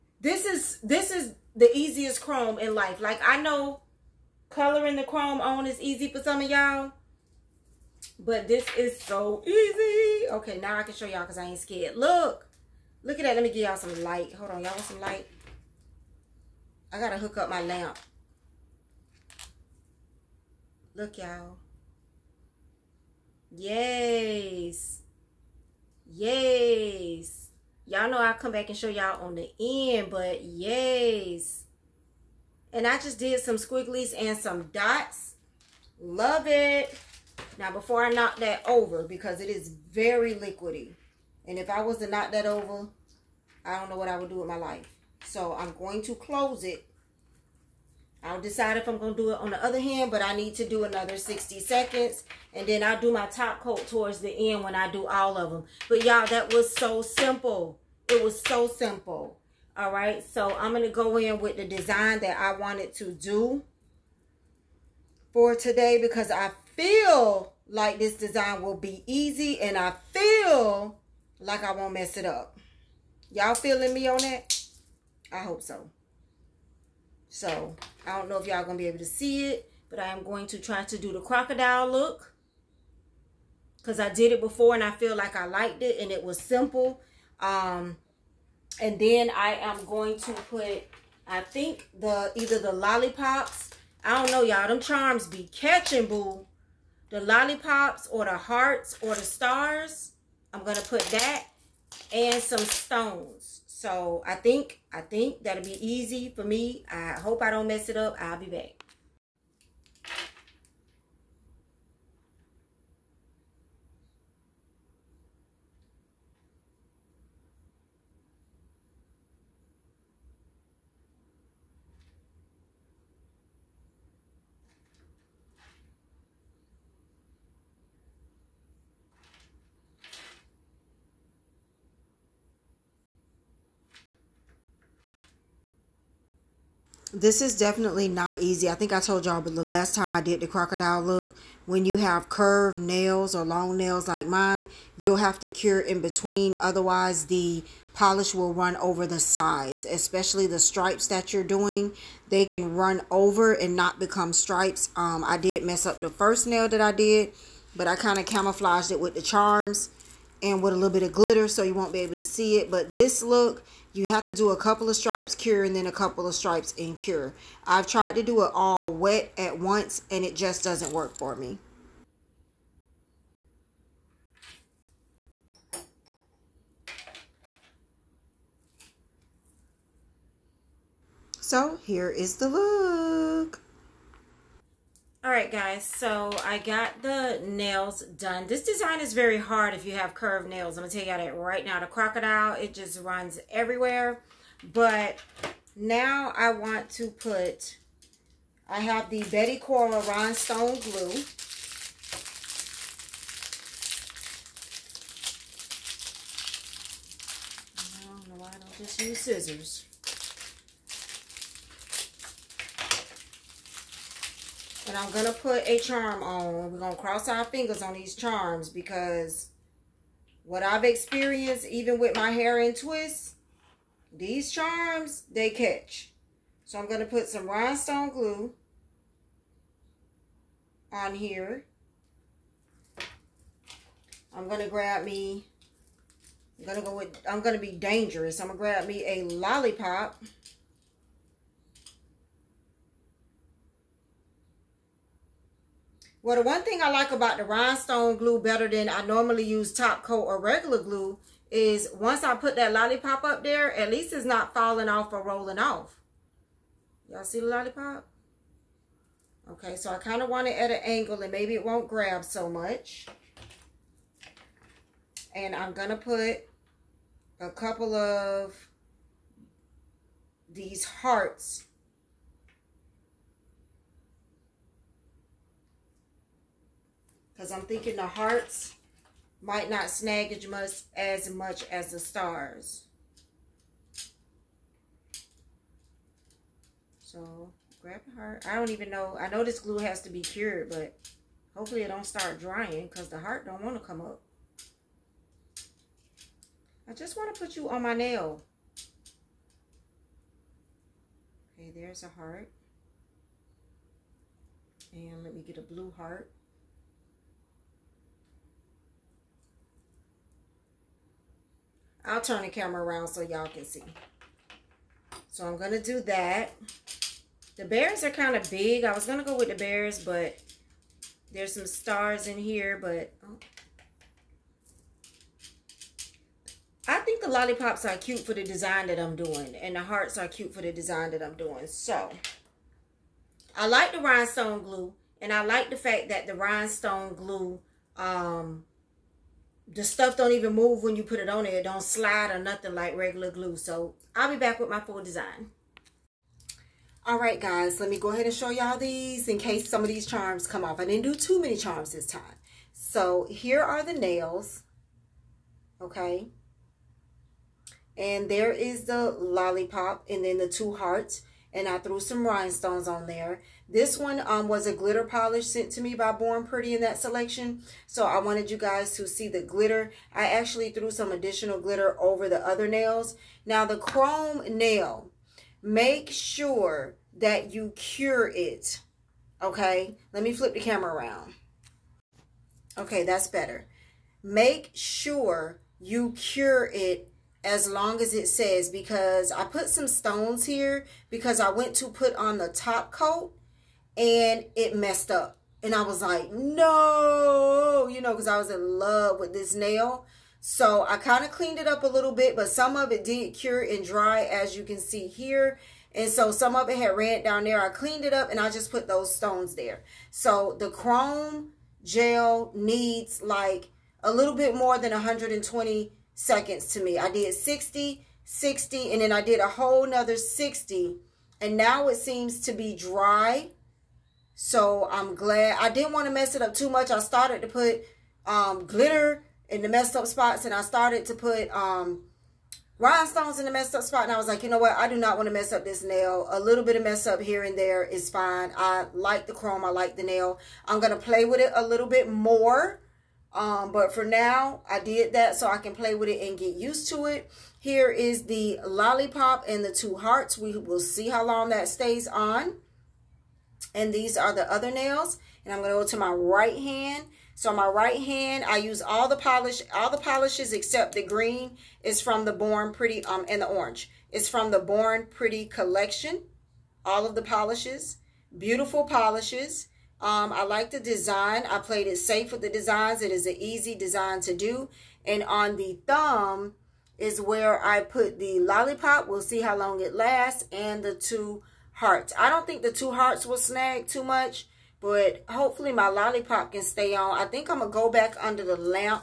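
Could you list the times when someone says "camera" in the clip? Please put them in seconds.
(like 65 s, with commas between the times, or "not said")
312 s, 380 s.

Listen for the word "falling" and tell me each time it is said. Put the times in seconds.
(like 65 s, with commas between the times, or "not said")
254 s.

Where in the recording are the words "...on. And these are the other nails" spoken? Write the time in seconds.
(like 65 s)
452 s.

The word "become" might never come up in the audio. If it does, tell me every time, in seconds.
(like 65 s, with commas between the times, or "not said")
153 s.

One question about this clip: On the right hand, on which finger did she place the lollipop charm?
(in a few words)
thumb.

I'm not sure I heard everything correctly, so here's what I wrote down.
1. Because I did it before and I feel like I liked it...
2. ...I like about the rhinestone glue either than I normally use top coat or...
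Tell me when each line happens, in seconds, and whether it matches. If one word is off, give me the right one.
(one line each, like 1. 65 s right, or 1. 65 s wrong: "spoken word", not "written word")
1. 83 s right
2. 246 s wrong: "better", not "either".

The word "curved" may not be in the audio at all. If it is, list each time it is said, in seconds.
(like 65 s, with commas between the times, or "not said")
142 s, 190 s.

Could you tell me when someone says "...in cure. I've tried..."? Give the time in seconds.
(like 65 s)
166 s.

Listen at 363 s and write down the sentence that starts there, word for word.
This one um, was a glitter polish sent to me by Born Pretty in that selection.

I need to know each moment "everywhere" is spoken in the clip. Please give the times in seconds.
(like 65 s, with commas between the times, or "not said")
193 s.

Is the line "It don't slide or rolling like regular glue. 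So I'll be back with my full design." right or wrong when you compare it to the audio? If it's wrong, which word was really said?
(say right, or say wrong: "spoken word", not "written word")
wrong: "nothing", not "rolling".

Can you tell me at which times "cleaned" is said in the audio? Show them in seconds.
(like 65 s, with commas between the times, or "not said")
401 s, 407 s.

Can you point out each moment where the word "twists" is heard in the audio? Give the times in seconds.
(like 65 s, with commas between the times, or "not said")
222 s.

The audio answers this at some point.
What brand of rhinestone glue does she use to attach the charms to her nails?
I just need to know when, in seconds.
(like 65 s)
199 s.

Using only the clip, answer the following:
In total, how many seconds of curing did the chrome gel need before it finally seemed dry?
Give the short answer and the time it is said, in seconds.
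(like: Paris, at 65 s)
180, at 417 s.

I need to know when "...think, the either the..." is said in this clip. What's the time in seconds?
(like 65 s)
91 s.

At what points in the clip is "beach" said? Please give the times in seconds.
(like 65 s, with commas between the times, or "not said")
not said.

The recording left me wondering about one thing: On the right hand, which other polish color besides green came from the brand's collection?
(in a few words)
orange.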